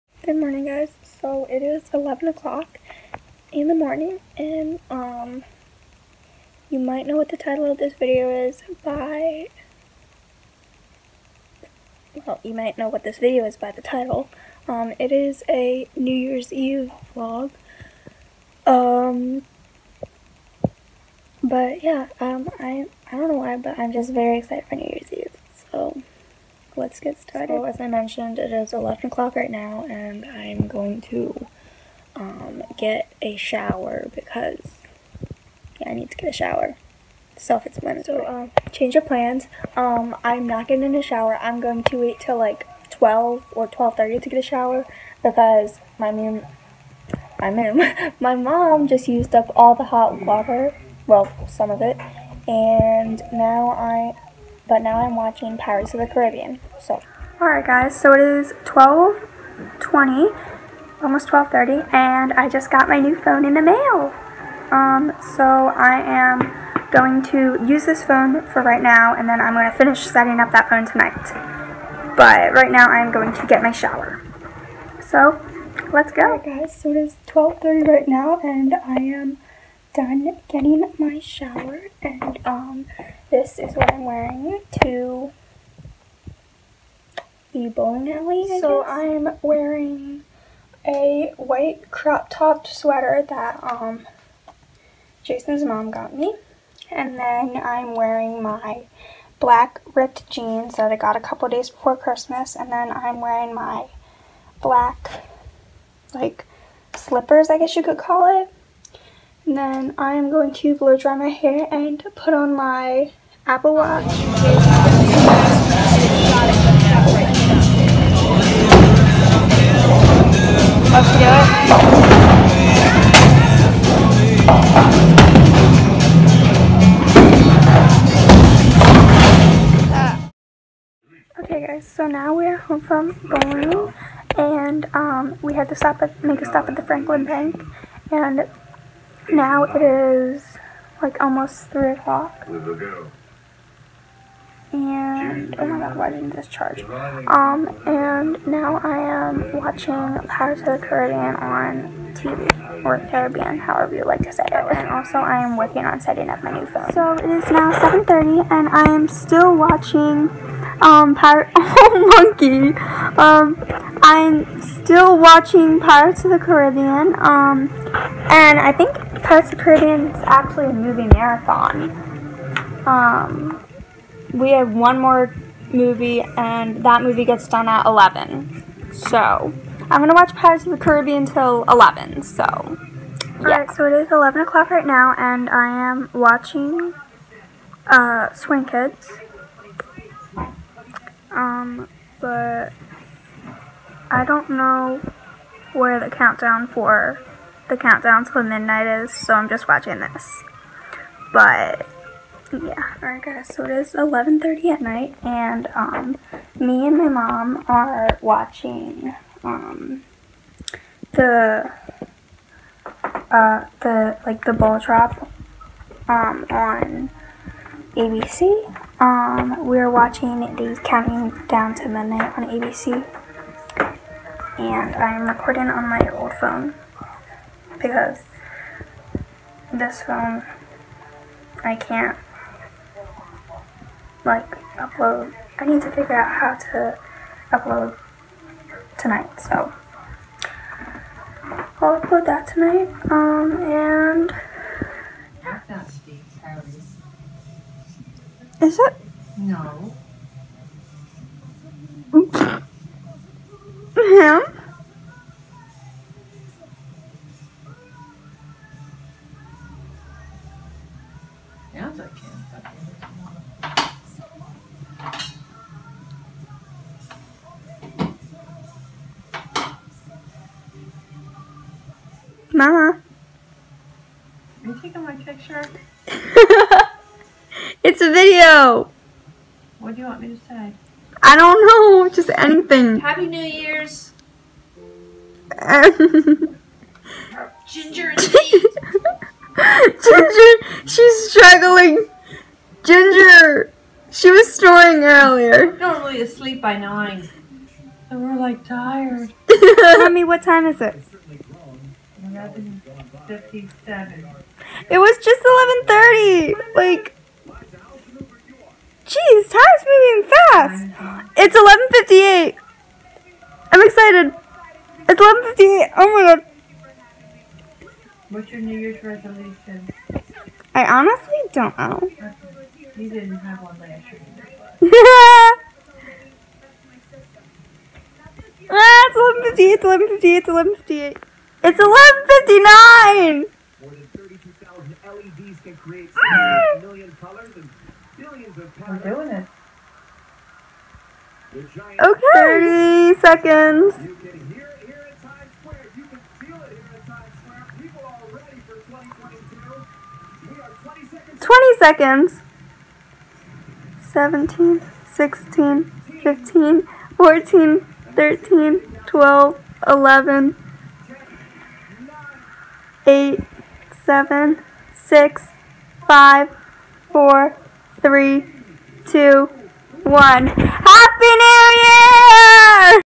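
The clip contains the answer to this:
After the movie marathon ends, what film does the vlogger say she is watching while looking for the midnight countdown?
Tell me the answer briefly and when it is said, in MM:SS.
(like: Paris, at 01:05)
Swing Kids, at 03:08.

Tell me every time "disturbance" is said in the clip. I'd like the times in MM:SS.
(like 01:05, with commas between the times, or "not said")
not said.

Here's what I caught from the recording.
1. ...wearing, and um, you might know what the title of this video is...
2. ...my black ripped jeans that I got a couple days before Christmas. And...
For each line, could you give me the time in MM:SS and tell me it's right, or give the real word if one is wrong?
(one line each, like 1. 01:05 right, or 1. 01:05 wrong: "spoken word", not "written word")
1. 00:03 wrong: "morning", not "wearing"
2. 01:38 right.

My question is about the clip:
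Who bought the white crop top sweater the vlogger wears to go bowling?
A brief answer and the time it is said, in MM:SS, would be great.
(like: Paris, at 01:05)
Jason's mom, at 01:35.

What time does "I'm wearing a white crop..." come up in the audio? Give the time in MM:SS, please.
01:28.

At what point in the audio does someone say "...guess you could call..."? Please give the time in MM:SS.
01:47.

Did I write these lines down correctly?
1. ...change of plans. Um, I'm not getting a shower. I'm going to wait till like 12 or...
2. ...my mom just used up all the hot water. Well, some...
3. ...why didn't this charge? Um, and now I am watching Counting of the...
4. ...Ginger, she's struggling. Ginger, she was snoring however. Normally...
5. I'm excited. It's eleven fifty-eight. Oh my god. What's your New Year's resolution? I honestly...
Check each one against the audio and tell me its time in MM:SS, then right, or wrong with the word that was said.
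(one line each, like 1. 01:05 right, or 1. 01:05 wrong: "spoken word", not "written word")
1. 00:38 right
2. 00:48 right
3. 02:25 wrong: "Pirates", not "Counting"
4. 04:50 wrong: "earlier", not "however"
5. 05:13 right.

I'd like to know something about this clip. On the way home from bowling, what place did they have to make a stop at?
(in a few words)
Franklin Bank.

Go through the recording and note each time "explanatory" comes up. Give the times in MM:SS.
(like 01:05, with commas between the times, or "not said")
00:37.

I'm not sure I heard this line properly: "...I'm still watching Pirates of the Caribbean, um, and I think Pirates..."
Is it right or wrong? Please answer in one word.
right.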